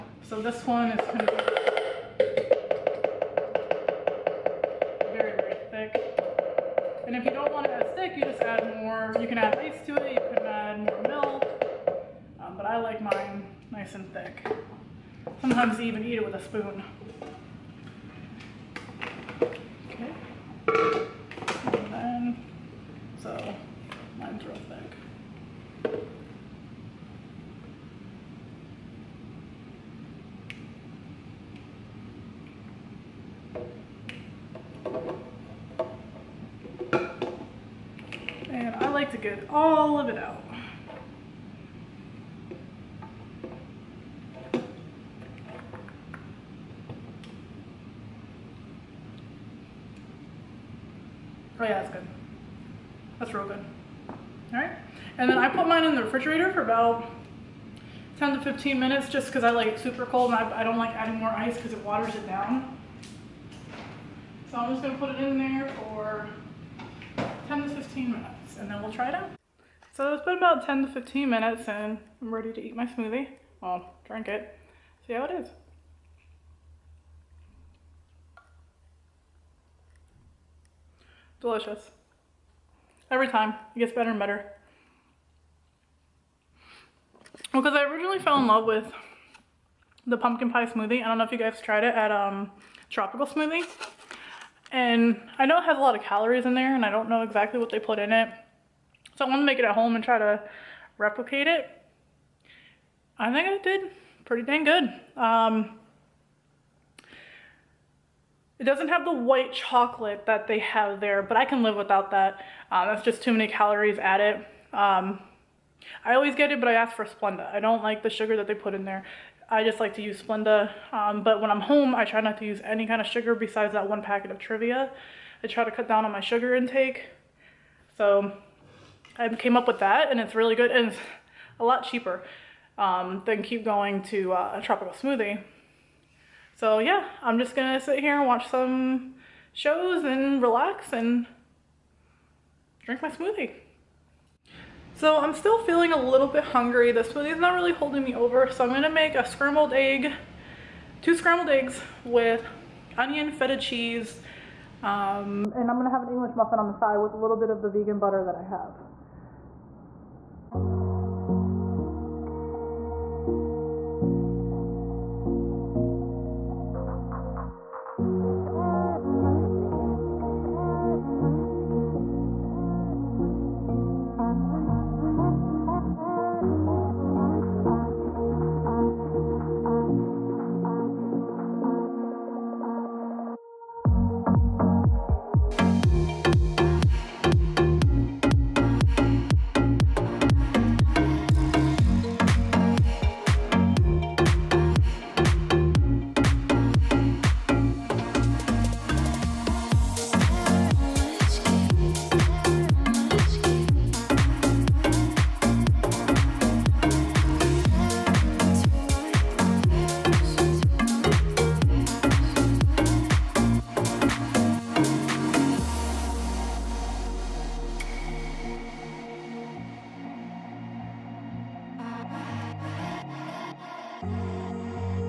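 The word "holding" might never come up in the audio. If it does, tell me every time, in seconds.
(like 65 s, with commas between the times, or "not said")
147 s.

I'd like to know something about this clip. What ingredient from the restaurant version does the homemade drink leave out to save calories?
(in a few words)
white chocolate.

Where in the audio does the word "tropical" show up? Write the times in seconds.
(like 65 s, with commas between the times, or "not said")
92 s, 134 s.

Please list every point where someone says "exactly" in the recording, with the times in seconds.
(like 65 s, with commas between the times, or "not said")
97 s.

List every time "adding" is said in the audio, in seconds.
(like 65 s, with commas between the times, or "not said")
60 s.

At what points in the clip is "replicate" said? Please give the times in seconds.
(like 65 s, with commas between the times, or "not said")
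100 s.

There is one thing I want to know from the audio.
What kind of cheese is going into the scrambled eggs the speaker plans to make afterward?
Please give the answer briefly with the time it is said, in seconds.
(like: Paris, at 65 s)
feta, at 153 s.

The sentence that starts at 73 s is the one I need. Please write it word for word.
Well, drink it, see how it is.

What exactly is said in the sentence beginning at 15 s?
Sometimes you even eat it with a spoon.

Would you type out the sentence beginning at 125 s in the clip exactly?
I try to cut down on my sugar intake.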